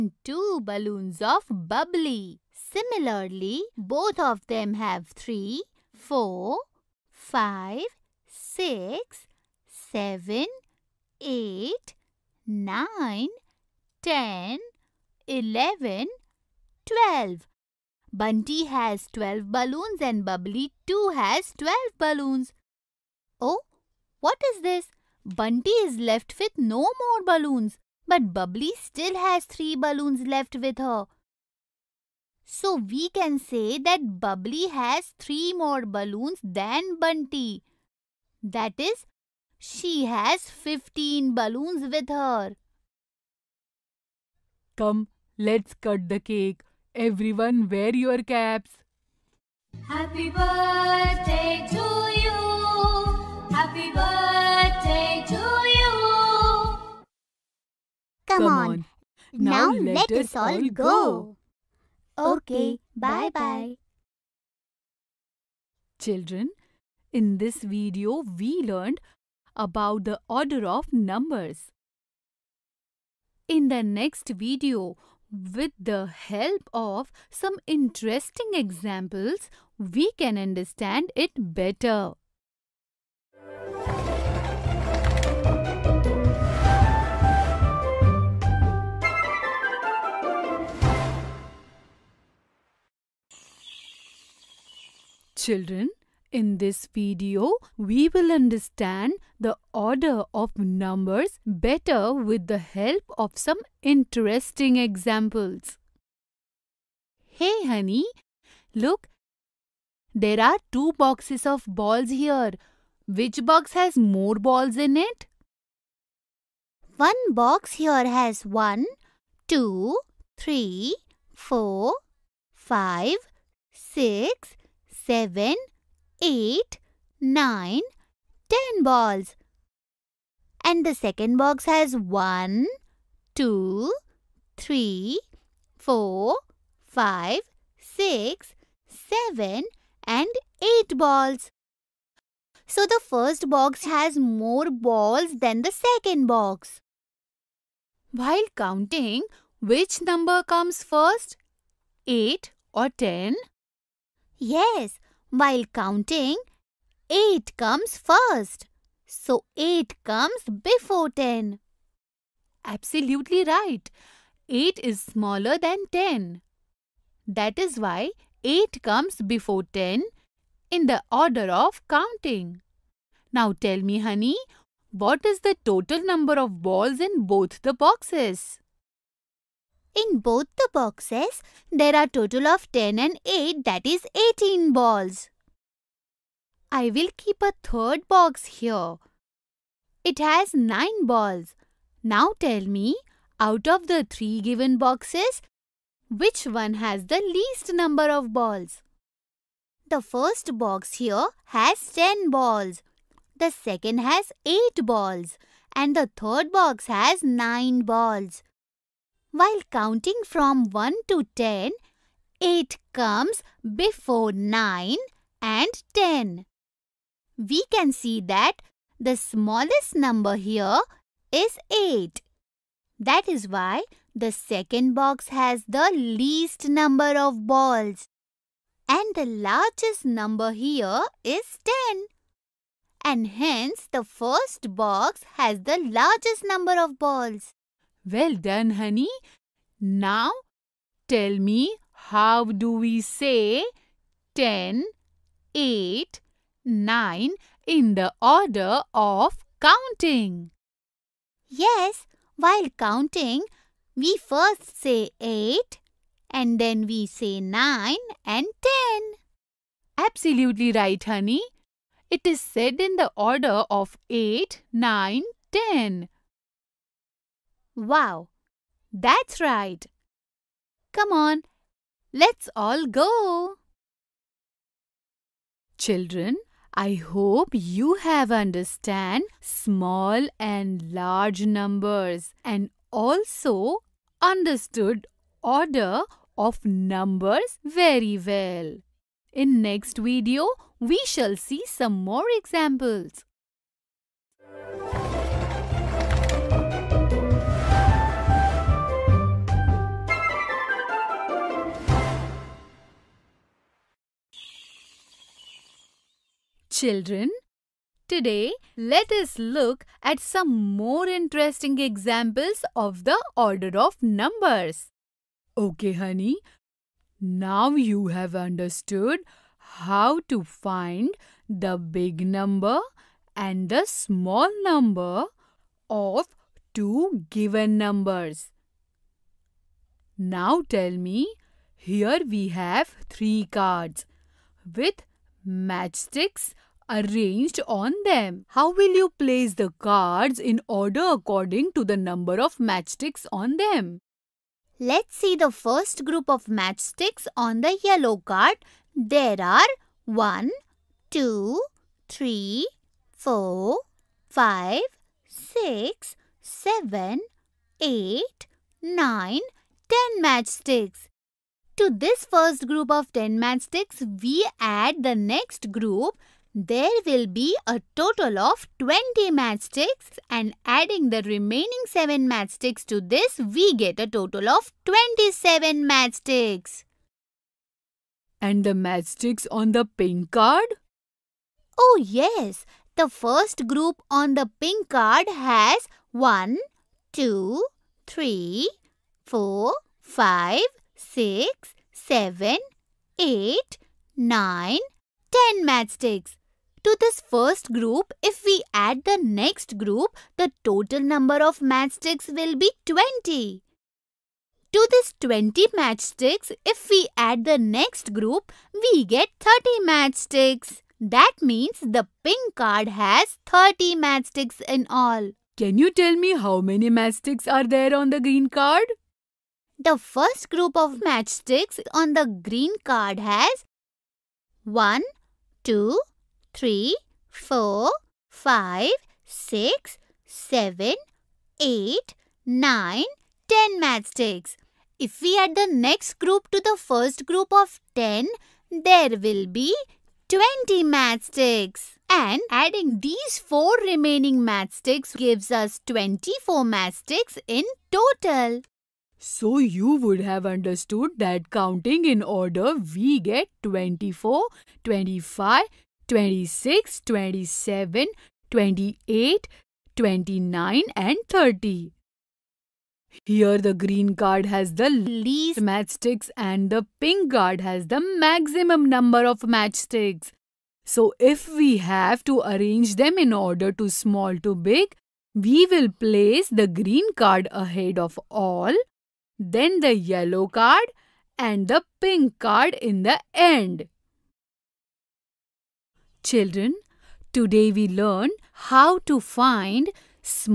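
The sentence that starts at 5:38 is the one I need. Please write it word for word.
How will you place the cards in order according to the number of matchsticks on them?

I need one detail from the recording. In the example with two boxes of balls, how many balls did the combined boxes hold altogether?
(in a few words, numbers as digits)
18.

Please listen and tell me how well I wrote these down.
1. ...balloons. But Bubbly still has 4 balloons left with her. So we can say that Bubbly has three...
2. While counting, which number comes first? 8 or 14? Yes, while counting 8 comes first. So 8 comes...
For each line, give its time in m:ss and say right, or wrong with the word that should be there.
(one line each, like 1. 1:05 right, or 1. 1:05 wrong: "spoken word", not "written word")
1. 0:27 wrong: "3", not "4"
2. 2:28 wrong: "10", not "14".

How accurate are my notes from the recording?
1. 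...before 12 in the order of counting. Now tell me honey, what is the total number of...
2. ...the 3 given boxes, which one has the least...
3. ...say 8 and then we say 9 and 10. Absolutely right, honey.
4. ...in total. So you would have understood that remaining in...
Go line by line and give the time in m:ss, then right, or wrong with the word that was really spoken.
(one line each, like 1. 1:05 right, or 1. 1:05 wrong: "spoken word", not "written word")
1. 2:49 wrong: "10", not "12"
2. 3:13 right
3. 4:14 right
4. 7:27 wrong: "counting", not "remaining".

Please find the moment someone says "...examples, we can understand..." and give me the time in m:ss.
1:18.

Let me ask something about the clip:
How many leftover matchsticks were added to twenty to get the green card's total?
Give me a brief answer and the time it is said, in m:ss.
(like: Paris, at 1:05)
4, at 7:23.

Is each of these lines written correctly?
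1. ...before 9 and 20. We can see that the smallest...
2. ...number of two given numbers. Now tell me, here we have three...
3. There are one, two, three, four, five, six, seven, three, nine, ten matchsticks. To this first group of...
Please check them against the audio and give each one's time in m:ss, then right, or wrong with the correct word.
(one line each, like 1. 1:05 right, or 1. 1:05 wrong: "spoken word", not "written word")
1. 3:33 wrong: "10", not "20"
2. 5:24 right
3. 5:48 wrong: "eight", not "three".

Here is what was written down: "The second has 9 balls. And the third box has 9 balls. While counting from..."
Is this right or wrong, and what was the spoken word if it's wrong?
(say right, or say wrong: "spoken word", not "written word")
wrong: "8", not "9".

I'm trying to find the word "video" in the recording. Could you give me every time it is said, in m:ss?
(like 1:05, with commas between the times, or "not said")
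1:07, 1:14, 1:36, 4:49.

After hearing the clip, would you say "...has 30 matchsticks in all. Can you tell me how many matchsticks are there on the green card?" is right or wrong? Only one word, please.
right.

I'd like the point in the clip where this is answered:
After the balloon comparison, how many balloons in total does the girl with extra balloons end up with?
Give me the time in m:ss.
0:40.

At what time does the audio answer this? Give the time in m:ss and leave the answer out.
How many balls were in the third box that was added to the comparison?
3:10.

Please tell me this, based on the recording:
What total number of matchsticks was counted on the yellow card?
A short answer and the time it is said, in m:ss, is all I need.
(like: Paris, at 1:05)
27, at 6:14.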